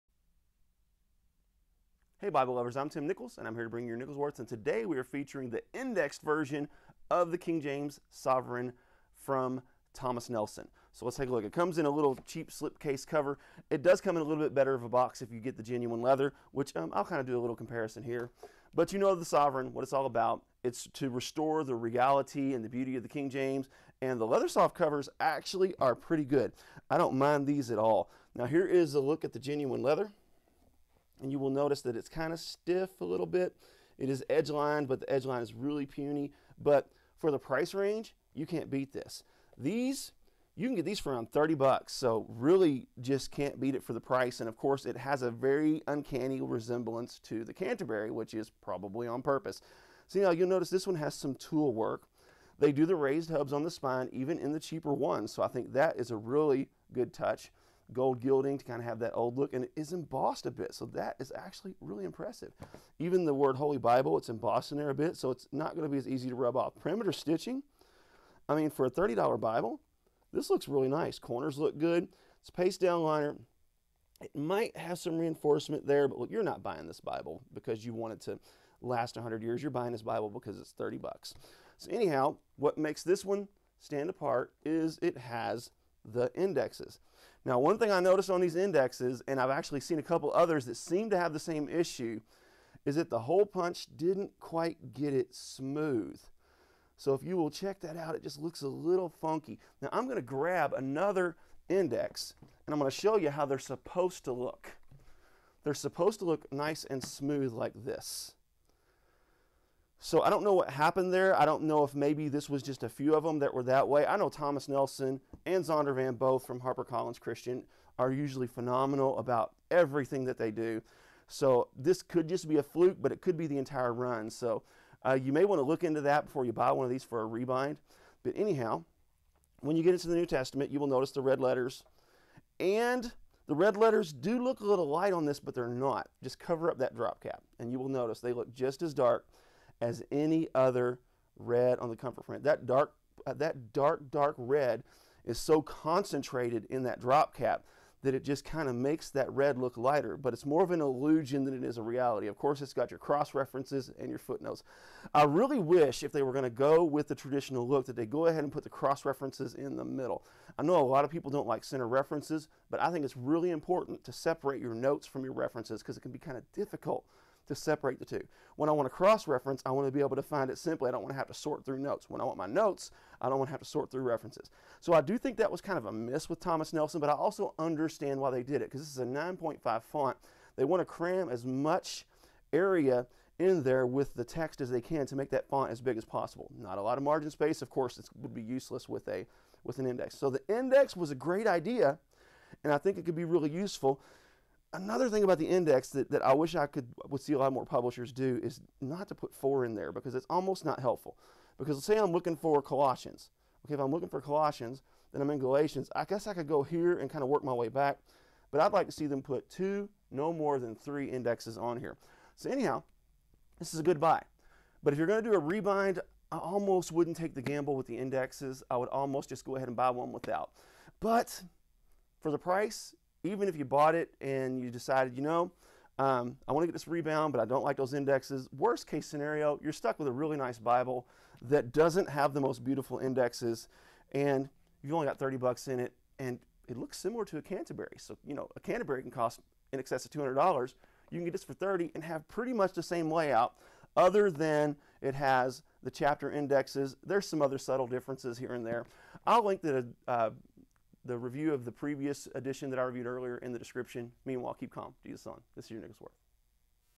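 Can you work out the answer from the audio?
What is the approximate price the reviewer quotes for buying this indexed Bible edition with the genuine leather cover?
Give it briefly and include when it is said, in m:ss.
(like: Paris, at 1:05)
30 bucks, at 0:41.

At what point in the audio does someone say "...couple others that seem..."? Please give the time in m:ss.
1:30.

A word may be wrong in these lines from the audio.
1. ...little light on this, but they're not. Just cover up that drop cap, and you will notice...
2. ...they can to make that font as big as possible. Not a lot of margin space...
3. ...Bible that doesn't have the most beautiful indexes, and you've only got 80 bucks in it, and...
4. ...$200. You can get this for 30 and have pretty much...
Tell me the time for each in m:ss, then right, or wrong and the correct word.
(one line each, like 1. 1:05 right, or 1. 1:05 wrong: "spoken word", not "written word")
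1. 2:14 right
2. 3:04 right
3. 3:50 wrong: "30", not "80"
4. 4:00 right.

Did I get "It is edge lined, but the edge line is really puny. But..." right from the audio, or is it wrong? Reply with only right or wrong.
right.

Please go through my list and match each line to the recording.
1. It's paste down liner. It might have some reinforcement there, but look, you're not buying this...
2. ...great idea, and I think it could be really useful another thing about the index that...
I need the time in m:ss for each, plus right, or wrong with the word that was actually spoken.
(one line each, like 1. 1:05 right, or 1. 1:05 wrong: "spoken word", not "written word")
1. 1:12 right
2. 3:11 right.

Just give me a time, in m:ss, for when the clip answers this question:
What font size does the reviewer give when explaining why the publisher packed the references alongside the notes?
2:59.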